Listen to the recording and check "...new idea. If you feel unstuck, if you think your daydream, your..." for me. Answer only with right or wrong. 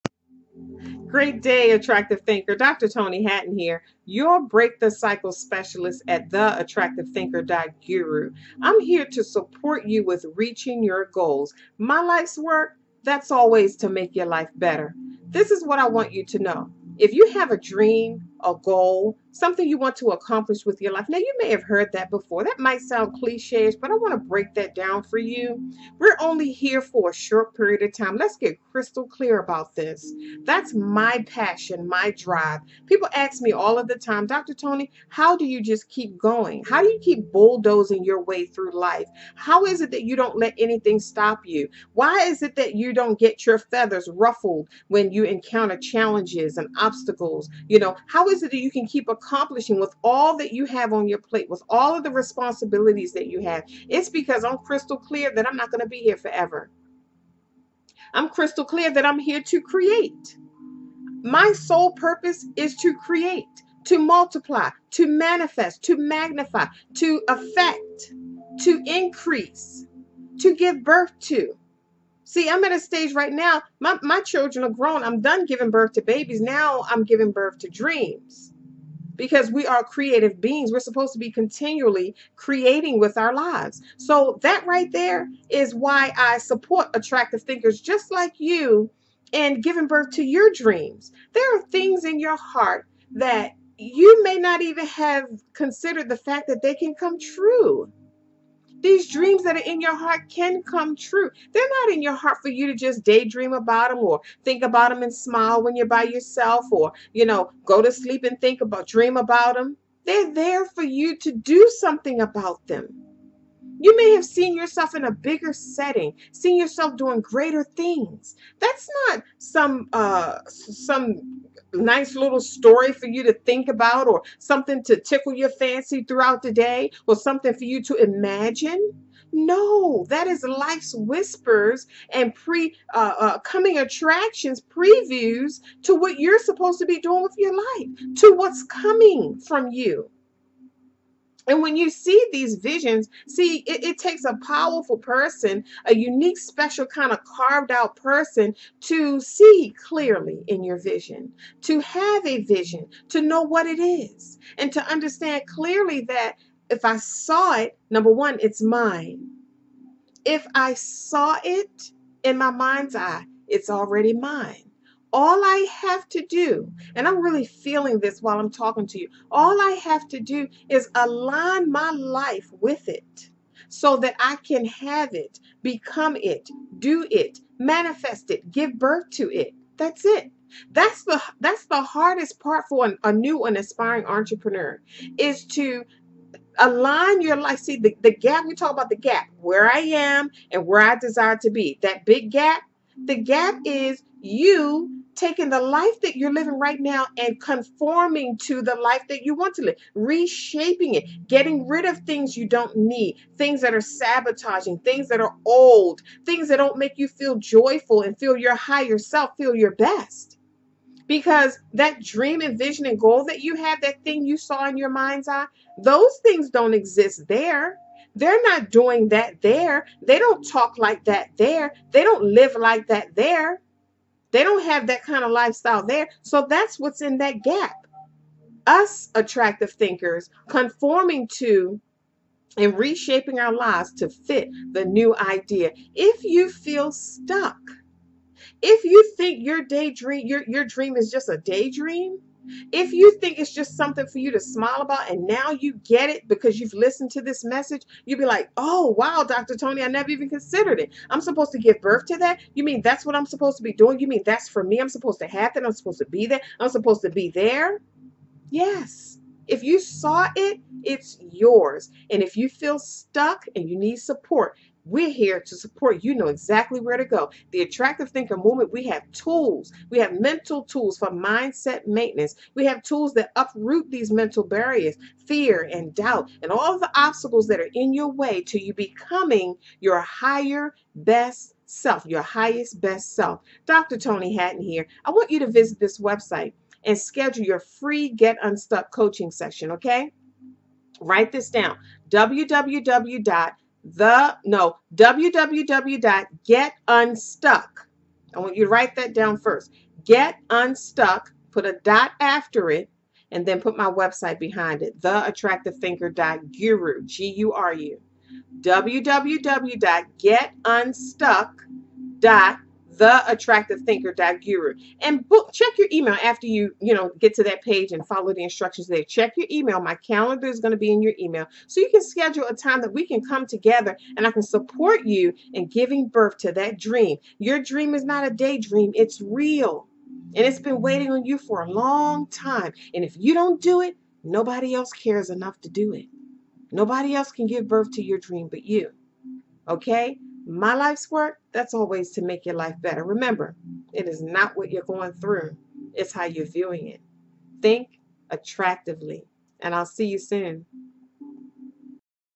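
wrong.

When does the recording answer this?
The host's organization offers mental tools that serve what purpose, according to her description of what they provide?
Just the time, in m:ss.
4:31.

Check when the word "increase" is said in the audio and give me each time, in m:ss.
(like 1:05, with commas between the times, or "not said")
1:08.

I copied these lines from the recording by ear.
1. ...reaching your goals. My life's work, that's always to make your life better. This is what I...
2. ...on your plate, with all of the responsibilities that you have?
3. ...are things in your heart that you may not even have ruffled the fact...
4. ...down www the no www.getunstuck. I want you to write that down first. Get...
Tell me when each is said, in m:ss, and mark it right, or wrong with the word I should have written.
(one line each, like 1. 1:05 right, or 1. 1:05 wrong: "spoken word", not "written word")
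1. 0:10 right
2. 0:50 right
3. 1:31 wrong: "considered", not "ruffled"
4. 4:51 right.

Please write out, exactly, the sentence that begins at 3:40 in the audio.
They don't talk like that there.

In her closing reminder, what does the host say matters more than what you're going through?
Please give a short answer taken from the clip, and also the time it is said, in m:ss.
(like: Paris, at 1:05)
how you're viewing it, at 5:46.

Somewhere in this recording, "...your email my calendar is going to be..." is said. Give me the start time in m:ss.
5:19.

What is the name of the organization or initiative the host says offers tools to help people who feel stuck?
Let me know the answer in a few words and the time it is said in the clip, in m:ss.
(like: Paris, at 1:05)
The Attractive Thinker Movement, at 4:27.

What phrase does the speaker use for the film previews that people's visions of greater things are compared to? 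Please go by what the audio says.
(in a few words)
coming attractions.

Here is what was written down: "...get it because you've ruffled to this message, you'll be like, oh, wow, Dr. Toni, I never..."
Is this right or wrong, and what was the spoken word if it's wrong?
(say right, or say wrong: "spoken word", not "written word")
wrong: "listened", not "ruffled".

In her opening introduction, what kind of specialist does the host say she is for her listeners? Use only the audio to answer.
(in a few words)
break the cycle specialist.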